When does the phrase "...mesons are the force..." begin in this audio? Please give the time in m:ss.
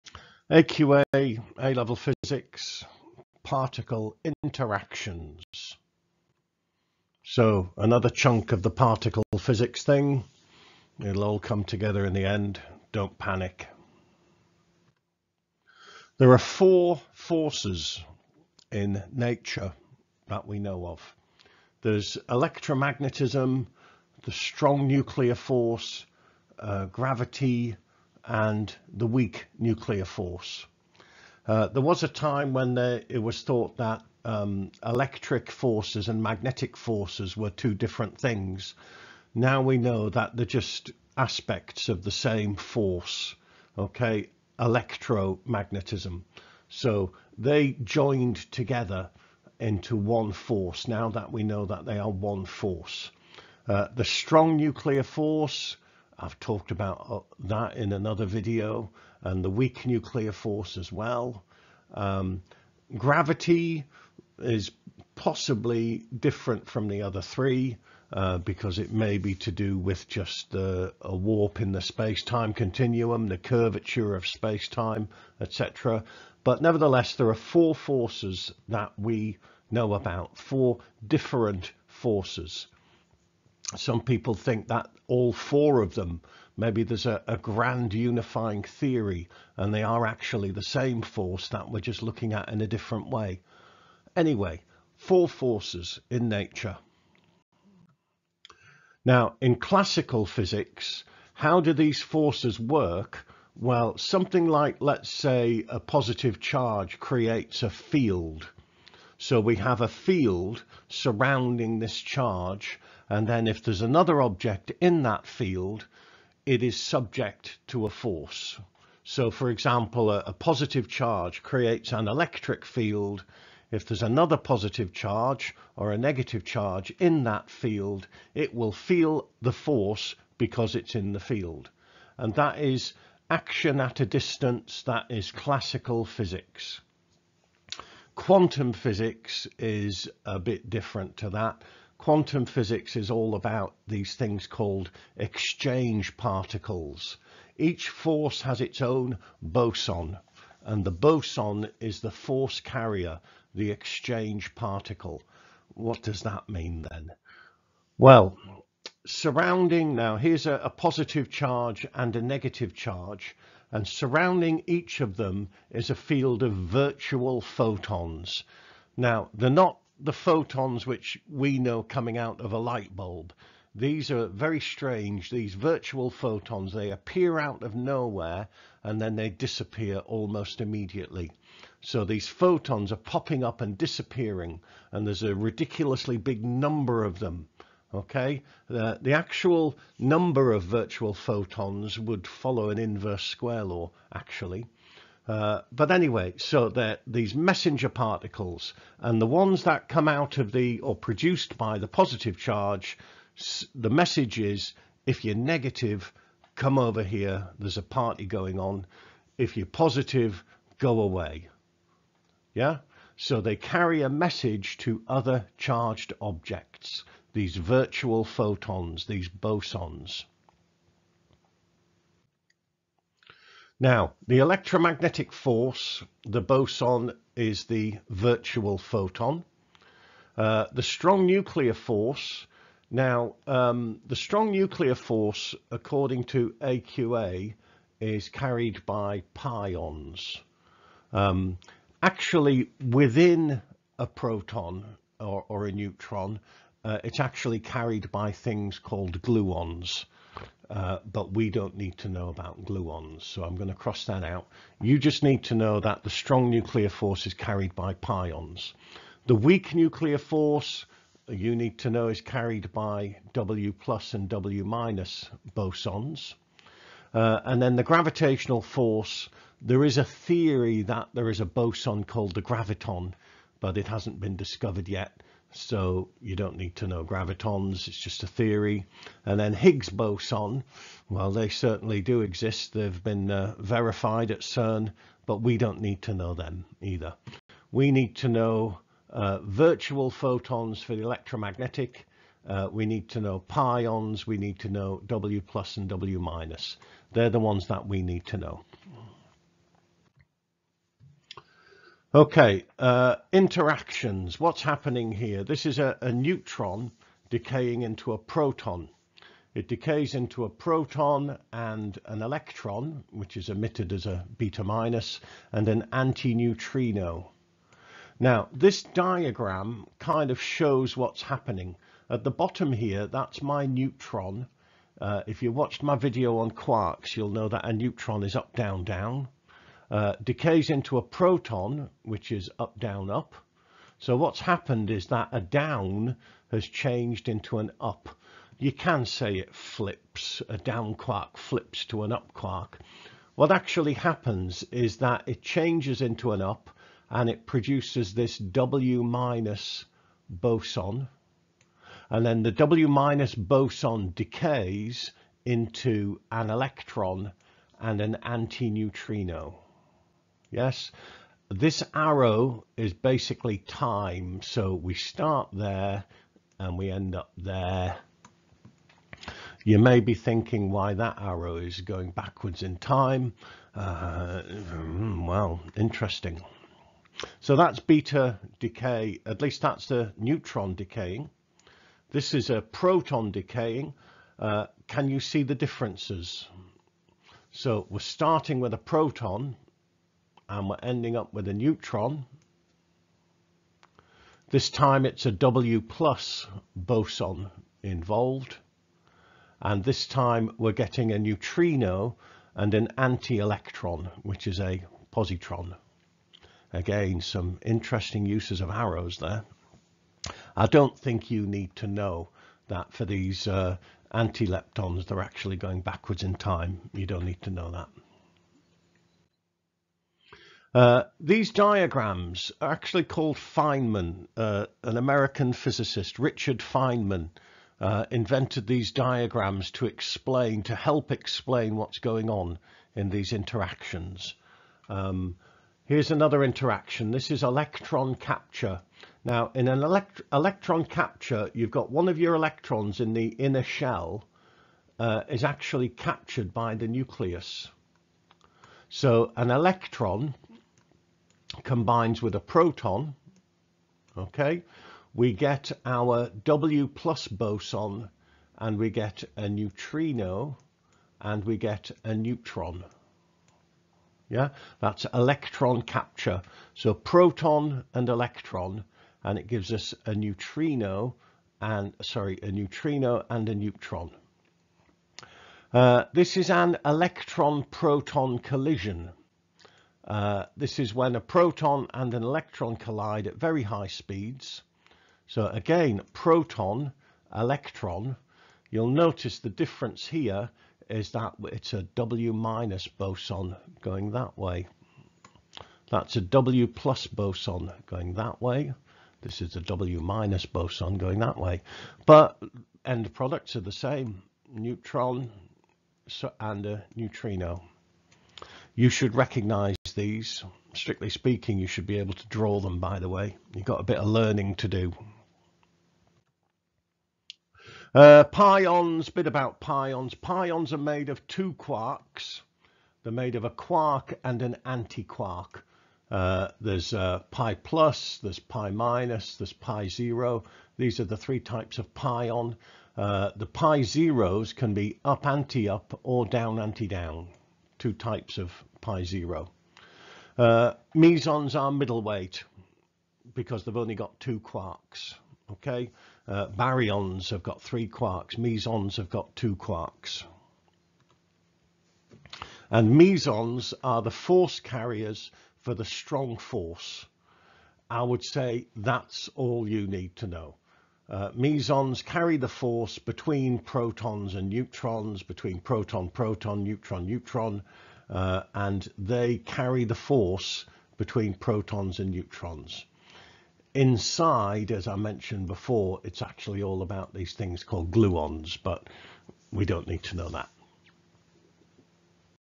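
9:12.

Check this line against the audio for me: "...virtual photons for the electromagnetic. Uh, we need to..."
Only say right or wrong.
right.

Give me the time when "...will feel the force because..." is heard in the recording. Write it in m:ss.
2:08.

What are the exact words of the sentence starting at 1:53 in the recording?
And then if there's another object in that field, it is subject to a force.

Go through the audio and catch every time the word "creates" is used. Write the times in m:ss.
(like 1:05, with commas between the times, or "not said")
1:46, 2:01.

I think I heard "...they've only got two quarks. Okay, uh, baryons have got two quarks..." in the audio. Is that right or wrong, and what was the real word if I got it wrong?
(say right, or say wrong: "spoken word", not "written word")
wrong: "three", not "two".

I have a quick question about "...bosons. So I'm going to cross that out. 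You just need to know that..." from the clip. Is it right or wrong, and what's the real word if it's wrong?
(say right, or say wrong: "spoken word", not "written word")
wrong: "gluons", not "bosons".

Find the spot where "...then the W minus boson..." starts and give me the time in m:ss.
5:52.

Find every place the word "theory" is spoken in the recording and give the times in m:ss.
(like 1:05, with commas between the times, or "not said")
1:28, 4:30, 4:38.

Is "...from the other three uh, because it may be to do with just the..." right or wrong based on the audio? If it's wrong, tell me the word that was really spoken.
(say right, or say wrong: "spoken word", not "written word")
right.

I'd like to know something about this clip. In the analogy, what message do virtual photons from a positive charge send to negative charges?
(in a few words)
There's a party going on.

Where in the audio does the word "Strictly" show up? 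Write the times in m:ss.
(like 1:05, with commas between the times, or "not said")
8:30.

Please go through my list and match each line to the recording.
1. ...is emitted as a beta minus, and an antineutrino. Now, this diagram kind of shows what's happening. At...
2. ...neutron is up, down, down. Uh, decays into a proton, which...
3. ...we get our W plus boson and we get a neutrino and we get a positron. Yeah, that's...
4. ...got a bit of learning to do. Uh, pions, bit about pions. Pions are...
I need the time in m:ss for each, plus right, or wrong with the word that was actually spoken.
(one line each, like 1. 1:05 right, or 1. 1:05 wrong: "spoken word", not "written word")
1. 5:13 right
2. 5:27 right
3. 7:35 wrong: "neutron", not "positron"
4. 8:33 right.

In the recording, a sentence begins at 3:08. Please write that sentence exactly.
The, the actual number of virtual photons would follow an inverse square law, actually.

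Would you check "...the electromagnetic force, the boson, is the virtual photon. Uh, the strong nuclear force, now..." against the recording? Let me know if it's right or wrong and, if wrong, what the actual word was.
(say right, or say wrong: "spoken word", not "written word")
right.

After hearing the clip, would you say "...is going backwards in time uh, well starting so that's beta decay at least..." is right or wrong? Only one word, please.
wrong.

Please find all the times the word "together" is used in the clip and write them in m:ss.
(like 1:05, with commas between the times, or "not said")
0:11, 0:48.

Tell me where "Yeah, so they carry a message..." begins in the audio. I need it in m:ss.
3:32.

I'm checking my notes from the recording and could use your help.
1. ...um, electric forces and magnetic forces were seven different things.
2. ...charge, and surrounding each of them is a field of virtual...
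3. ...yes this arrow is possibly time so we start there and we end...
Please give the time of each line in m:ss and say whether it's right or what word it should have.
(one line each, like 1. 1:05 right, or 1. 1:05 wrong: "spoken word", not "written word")
1. 0:34 wrong: "two", not "seven"
2. 2:42 right
3. 6:00 wrong: "basically", not "possibly".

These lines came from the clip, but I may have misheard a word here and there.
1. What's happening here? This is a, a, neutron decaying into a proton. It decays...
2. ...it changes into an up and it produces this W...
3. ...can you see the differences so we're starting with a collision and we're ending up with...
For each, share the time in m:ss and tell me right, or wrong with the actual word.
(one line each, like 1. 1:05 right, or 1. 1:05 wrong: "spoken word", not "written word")
1. 5:04 right
2. 5:45 right
3. 6:24 wrong: "proton", not "collision".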